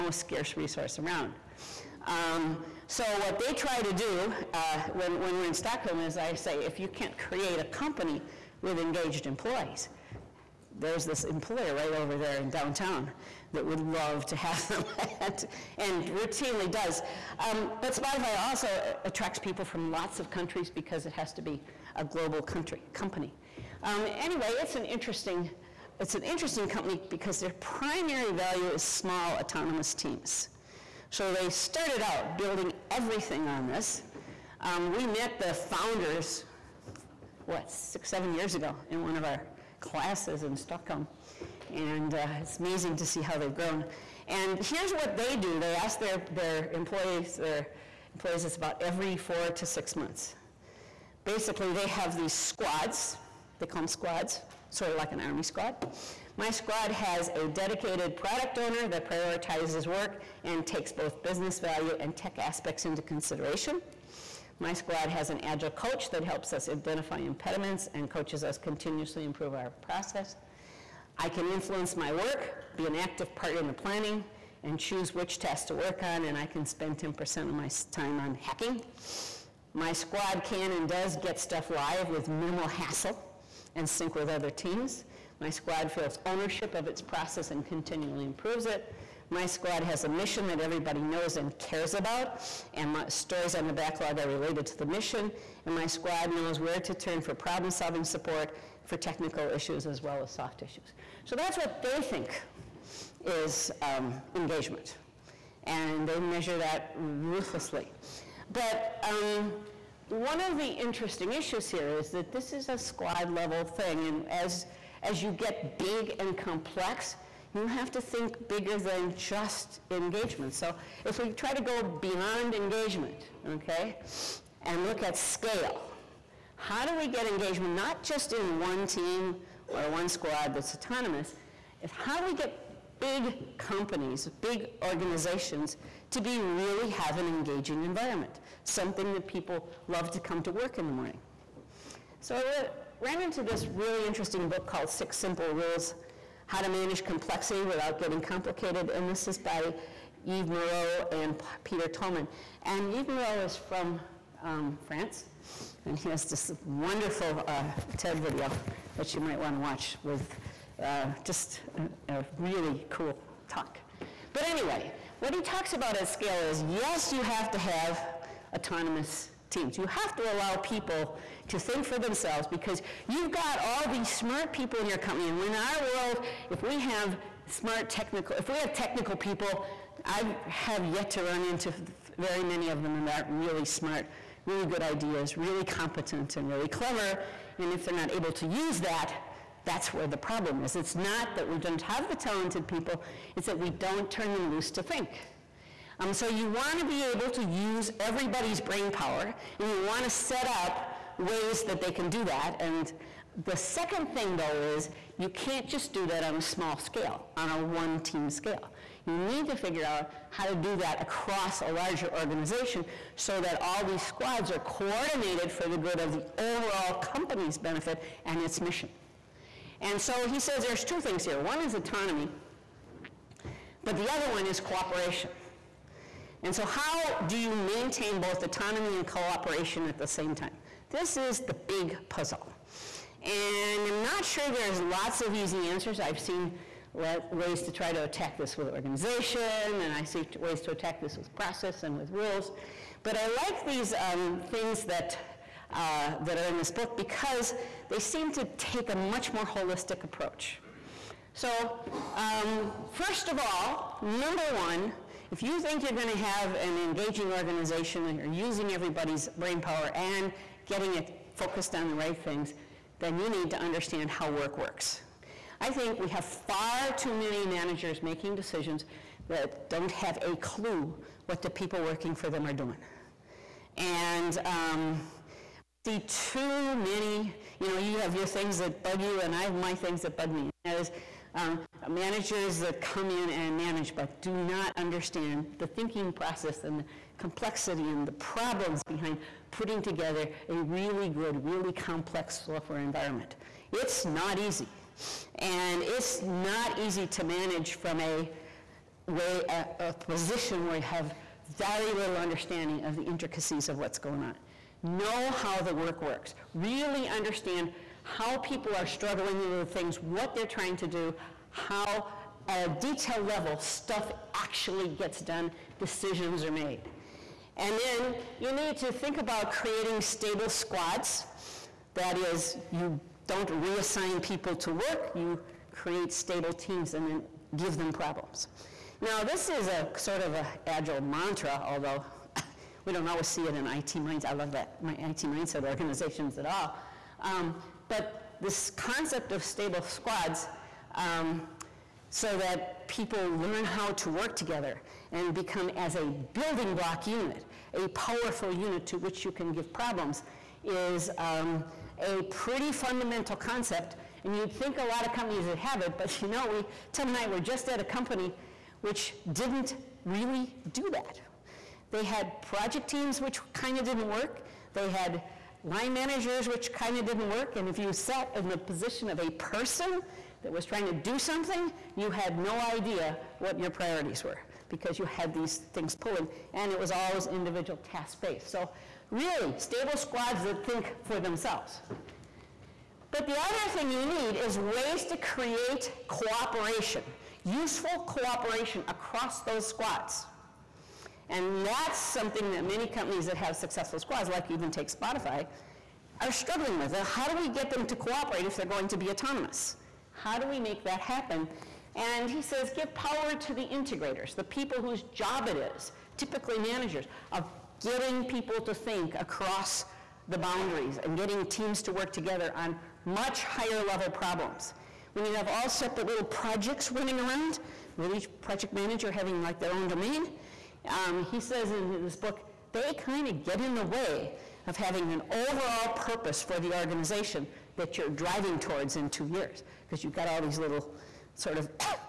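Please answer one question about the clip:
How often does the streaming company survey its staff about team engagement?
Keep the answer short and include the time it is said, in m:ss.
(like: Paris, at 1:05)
4 to 6 months, at 0:49.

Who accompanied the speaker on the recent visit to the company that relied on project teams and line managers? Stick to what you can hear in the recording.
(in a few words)
Tim.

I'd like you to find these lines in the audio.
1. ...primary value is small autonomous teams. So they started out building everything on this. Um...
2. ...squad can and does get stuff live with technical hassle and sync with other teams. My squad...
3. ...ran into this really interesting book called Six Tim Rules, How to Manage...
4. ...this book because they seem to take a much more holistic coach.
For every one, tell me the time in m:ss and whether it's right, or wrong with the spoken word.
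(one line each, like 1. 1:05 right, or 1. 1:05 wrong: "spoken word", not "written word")
1. 0:27 right
2. 1:19 wrong: "minimal", not "technical"
3. 2:23 wrong: "Simple", not "Tim"
4. 4:06 wrong: "approach", not "coach".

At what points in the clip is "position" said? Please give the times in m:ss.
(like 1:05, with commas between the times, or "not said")
4:59, 6:08.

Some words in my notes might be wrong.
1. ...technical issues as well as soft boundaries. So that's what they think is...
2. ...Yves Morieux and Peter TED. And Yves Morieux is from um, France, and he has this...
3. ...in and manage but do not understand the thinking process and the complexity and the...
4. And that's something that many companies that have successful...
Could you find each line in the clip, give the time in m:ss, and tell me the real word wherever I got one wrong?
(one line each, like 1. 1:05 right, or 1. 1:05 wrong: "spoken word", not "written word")
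1. 1:38 wrong: "issues", not "boundaries"
2. 2:30 wrong: "Tollman", not "TED"
3. 4:43 right
4. 6:31 right.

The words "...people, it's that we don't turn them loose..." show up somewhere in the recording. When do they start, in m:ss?
3:12.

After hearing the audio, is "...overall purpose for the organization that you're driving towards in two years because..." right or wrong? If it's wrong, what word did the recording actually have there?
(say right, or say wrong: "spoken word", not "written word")
right.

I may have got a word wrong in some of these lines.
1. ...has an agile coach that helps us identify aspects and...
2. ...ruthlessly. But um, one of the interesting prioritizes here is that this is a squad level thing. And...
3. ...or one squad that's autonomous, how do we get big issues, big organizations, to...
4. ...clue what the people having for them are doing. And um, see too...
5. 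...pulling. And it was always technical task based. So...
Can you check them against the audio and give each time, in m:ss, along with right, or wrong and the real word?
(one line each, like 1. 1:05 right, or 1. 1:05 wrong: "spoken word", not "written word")
1. 1:05 wrong: "impediments", not "aspects"
2. 1:46 wrong: "issues", not "prioritizes"
3. 2:09 wrong: "companies", not "issues"
4. 4:30 wrong: "working", not "having"
5. 6:15 wrong: "individual", not "technical".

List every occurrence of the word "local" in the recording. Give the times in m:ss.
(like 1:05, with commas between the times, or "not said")
not said.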